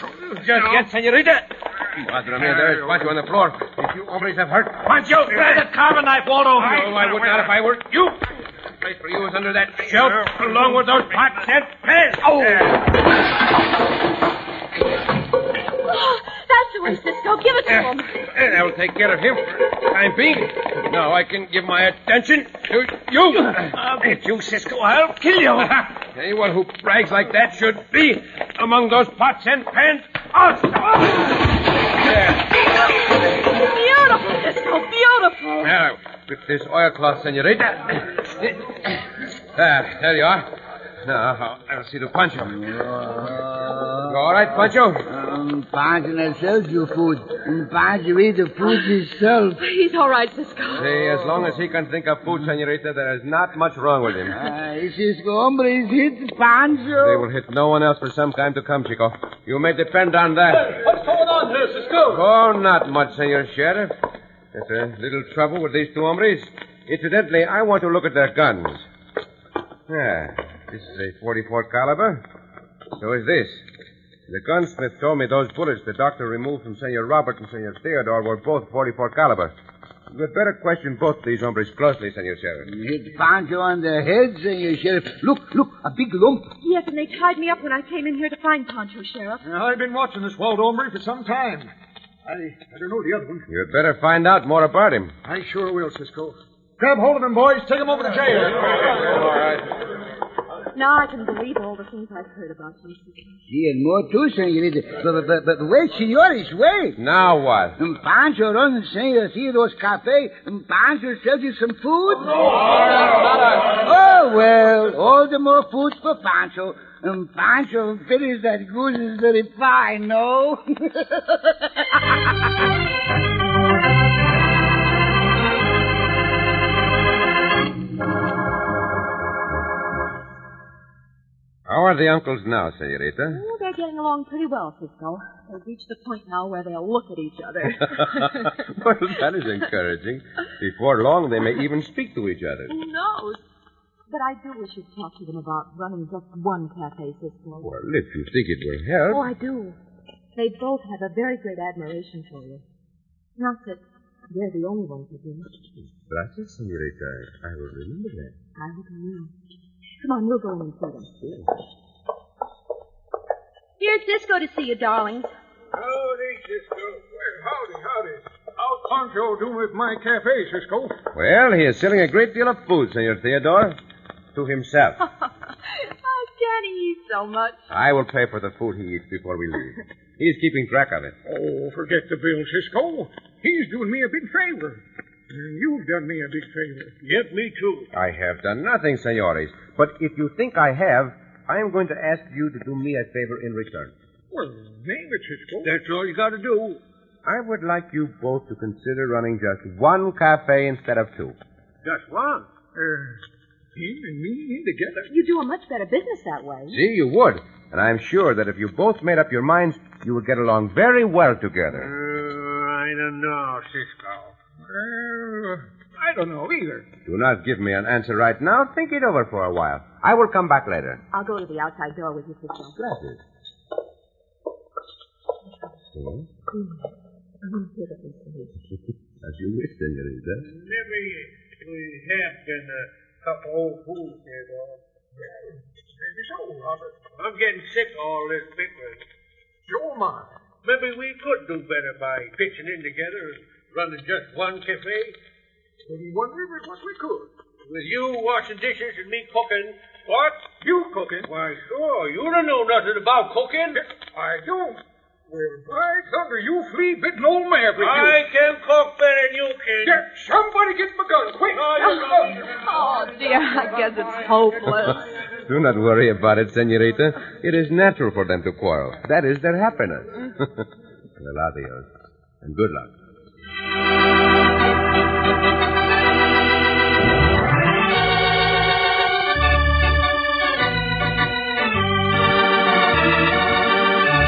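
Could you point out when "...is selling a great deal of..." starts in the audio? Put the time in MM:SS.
02:51.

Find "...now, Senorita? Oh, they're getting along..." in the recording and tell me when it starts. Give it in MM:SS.
02:12.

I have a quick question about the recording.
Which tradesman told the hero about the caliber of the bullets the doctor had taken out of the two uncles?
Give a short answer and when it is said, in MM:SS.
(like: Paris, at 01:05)
The gunsmith, at 01:14.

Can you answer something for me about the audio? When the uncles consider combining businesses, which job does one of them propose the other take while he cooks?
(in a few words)
Washing dishes.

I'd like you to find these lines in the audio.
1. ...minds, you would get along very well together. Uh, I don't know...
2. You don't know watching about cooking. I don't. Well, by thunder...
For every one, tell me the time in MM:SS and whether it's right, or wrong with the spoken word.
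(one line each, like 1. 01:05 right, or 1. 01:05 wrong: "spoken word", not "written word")
1. 03:29 right
2. 04:12 wrong: "nothing", not "watching".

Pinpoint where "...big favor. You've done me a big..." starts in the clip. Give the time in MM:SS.
03:04.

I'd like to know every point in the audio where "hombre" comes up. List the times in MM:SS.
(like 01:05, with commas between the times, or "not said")
00:55, 01:06, 01:21, 01:30.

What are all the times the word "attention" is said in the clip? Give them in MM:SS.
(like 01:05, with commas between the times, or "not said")
00:21.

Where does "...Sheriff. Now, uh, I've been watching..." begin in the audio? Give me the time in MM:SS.
01:29.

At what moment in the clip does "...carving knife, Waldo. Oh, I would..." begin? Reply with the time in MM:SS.
00:05.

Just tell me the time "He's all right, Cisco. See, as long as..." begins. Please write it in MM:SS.
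00:49.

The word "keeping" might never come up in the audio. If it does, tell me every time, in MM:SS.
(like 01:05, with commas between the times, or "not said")
03:00.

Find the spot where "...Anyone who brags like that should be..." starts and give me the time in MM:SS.
00:26.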